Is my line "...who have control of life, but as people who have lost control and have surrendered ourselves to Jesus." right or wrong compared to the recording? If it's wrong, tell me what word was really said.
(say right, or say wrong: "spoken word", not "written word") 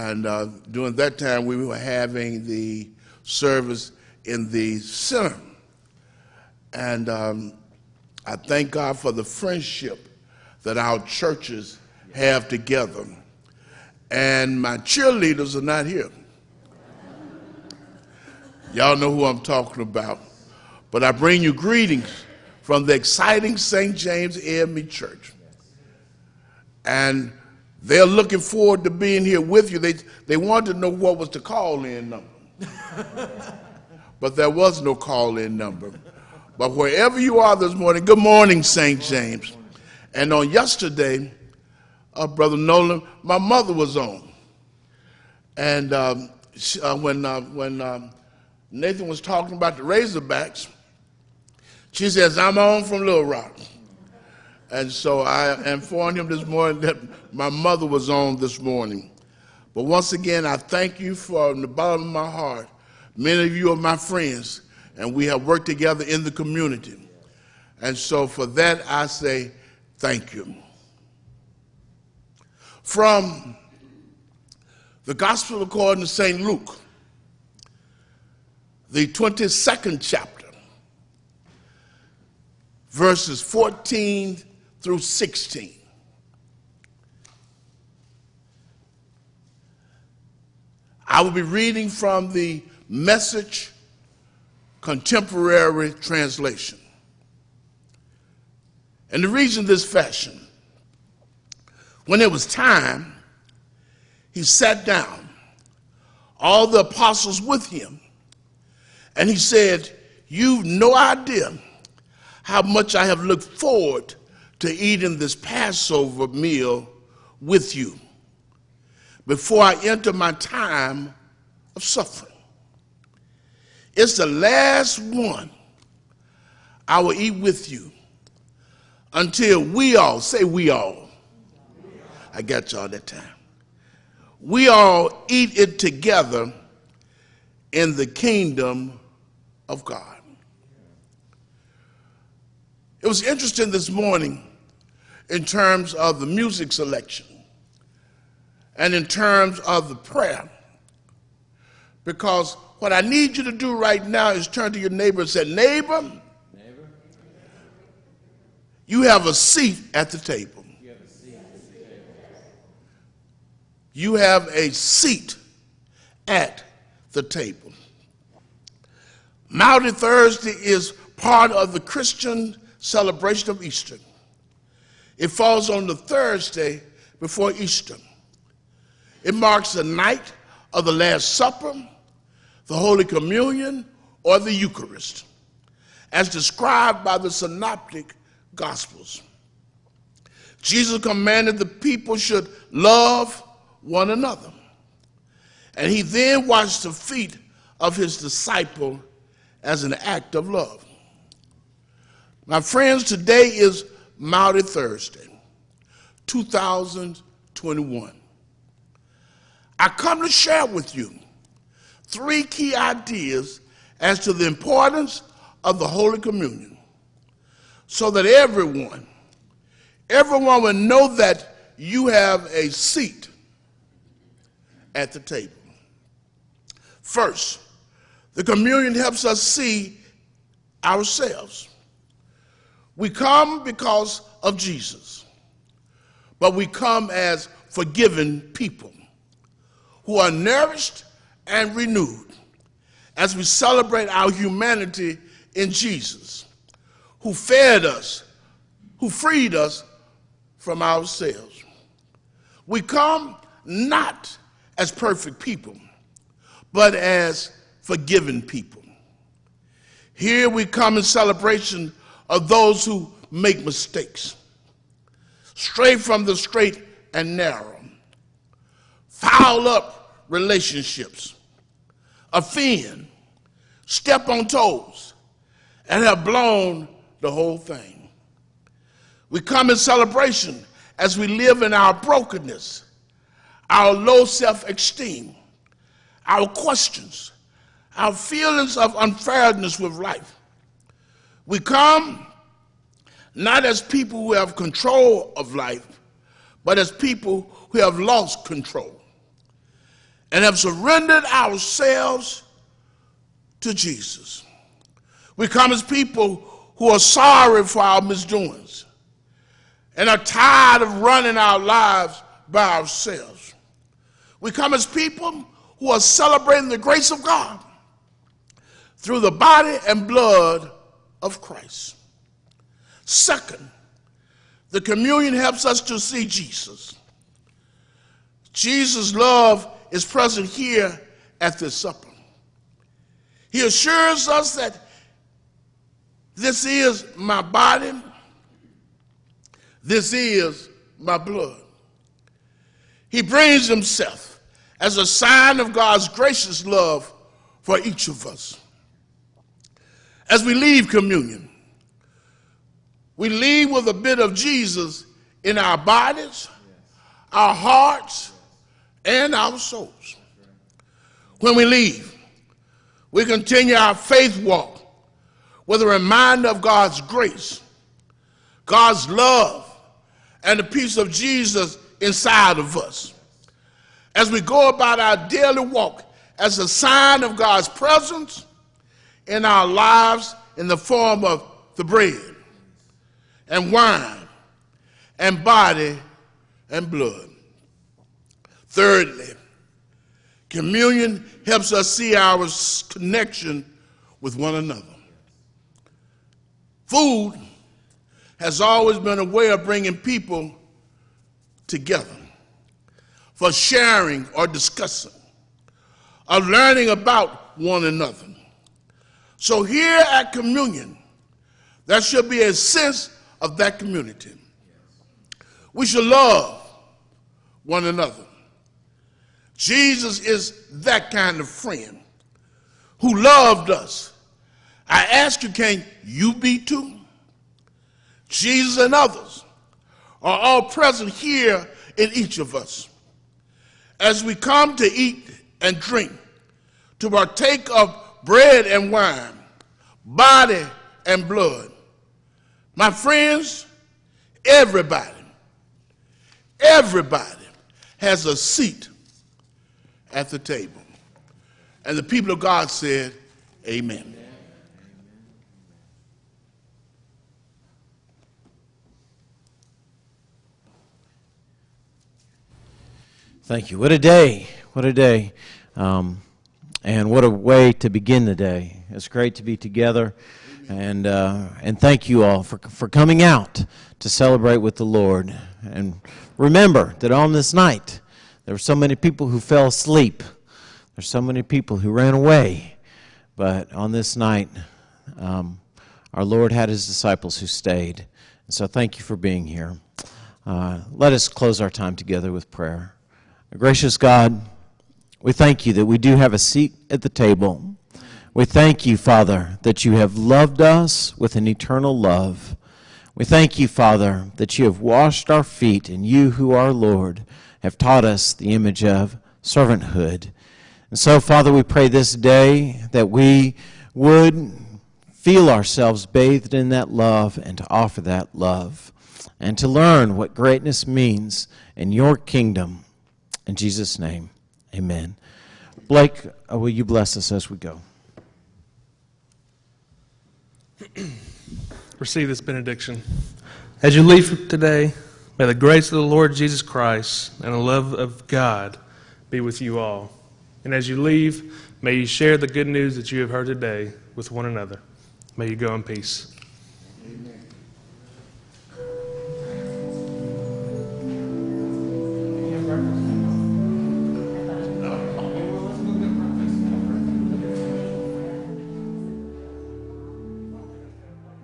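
right.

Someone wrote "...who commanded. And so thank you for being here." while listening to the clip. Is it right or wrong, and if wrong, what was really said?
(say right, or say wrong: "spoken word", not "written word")
wrong: "stayed", not "commanded".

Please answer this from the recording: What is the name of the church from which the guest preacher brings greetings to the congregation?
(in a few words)
St. James AME Church.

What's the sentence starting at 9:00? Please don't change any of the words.
And as you leave, may you share the good news that you have heard today with one another.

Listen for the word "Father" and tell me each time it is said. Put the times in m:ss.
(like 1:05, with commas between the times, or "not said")
8:18, 8:23, 8:31.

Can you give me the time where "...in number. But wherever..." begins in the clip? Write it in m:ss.
0:35.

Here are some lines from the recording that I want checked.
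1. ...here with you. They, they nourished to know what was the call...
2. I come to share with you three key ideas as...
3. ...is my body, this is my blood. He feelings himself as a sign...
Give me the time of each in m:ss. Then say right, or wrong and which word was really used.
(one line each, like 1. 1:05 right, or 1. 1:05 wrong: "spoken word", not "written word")
1. 0:29 wrong: "wanted", not "nourished"
2. 3:29 right
3. 5:36 wrong: "brings", not "feelings".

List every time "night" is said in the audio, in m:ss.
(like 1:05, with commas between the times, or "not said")
2:59, 7:57, 8:04.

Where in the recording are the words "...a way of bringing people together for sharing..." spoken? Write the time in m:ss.
6:39.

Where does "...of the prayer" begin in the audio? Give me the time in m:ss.
2:29.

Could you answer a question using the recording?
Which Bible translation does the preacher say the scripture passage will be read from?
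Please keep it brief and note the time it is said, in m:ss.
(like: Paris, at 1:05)
The Message, at 1:32.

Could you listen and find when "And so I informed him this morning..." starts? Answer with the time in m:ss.
0:54.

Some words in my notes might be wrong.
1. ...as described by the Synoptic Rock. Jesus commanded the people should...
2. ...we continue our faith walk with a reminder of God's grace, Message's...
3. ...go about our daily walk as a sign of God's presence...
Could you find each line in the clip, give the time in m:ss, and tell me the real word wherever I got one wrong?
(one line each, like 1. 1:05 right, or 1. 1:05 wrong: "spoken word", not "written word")
1. 3:06 wrong: "Gospels", not "Rock"
2. 6:03 wrong: "God", not "Message"
3. 6:14 right.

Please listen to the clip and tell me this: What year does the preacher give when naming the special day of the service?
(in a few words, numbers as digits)
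2021.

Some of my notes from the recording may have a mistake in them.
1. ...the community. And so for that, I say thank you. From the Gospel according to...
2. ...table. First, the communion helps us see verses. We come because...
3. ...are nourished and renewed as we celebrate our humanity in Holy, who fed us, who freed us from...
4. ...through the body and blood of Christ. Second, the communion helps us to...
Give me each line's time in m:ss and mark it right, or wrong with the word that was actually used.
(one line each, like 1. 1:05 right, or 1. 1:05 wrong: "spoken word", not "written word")
1. 1:06 right
2. 3:45 wrong: "ourselves", not "verses"
3. 4:00 wrong: "Jesus", not "Holy"
4. 5:19 right.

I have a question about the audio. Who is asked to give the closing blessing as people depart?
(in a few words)
Blake.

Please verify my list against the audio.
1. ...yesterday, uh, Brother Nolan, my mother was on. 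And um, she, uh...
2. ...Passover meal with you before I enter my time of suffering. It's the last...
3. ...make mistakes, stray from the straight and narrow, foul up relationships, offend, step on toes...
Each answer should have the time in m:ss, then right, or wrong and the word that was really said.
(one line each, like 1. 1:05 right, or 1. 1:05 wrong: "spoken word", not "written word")
1. 0:40 right
2. 1:55 right
3. 4:23 right.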